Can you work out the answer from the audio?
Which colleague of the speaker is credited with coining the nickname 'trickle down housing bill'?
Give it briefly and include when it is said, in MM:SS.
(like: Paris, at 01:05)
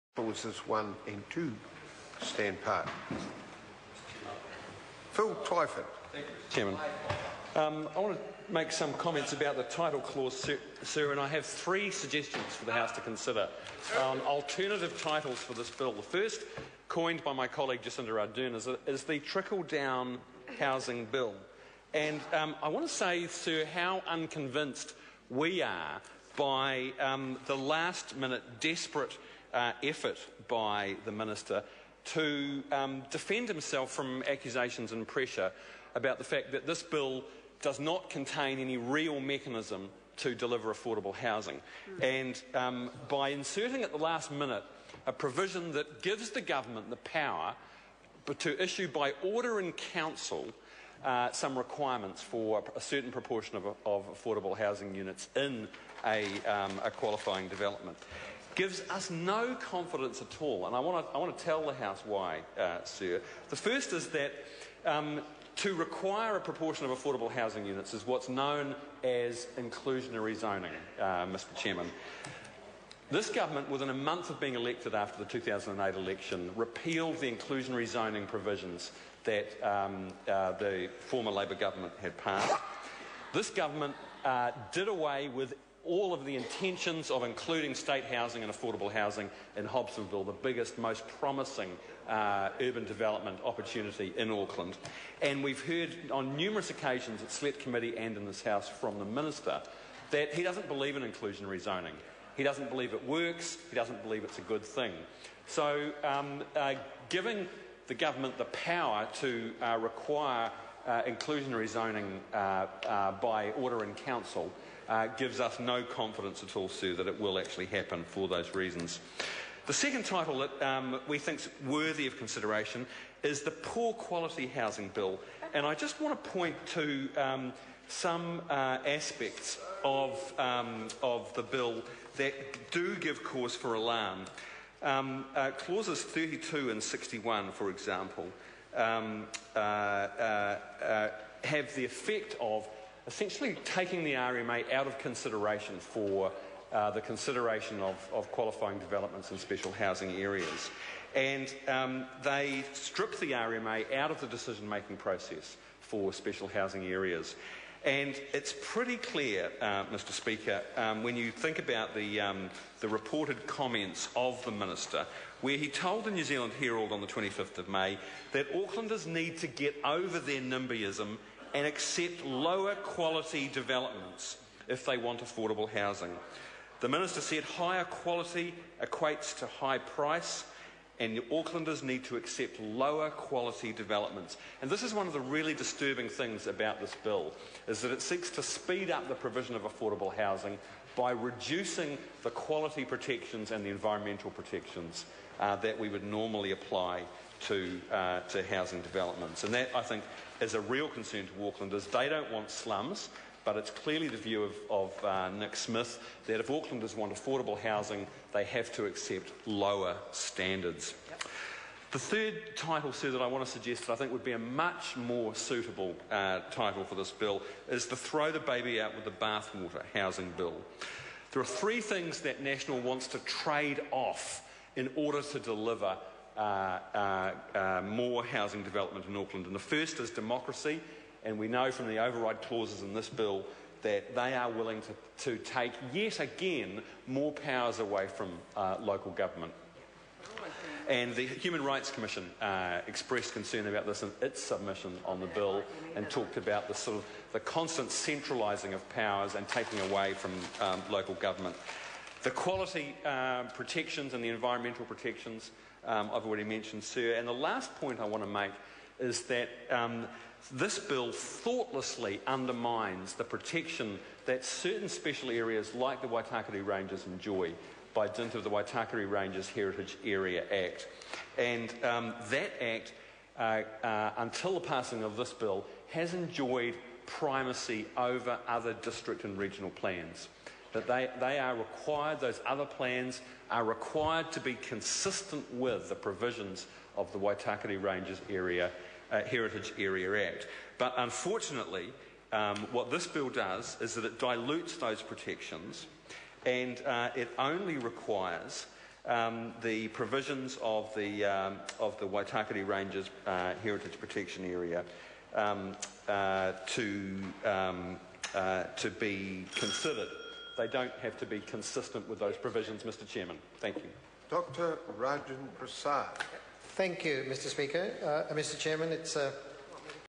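Jacinda Ardern, at 00:17.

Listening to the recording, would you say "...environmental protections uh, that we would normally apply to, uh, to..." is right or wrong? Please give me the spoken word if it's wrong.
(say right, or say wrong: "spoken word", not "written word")
right.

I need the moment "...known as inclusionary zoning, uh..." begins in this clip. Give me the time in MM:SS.
01:08.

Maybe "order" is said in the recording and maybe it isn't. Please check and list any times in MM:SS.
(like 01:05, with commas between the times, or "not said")
00:49, 01:53, 03:44.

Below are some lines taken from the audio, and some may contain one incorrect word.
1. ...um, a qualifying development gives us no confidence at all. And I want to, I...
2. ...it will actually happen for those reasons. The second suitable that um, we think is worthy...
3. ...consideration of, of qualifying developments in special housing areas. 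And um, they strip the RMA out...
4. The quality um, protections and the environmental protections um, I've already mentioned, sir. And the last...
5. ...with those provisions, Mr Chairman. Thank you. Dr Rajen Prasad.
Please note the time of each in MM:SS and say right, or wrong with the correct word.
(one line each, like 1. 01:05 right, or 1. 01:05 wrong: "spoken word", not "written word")
1. 00:56 right
2. 01:57 wrong: "title", not "suitable"
3. 02:27 right
4. 04:12 right
5. 05:12 right.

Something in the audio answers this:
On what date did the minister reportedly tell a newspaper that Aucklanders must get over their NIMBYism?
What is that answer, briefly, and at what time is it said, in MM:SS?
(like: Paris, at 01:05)
25 May, at 02:47.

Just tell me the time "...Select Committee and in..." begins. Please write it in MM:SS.
01:37.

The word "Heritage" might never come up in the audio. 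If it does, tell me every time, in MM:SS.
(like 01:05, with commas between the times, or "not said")
04:29, 04:49, 05:03.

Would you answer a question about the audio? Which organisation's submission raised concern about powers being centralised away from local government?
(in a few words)
Human Rights Commission.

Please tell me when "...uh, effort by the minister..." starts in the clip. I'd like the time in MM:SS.
00:29.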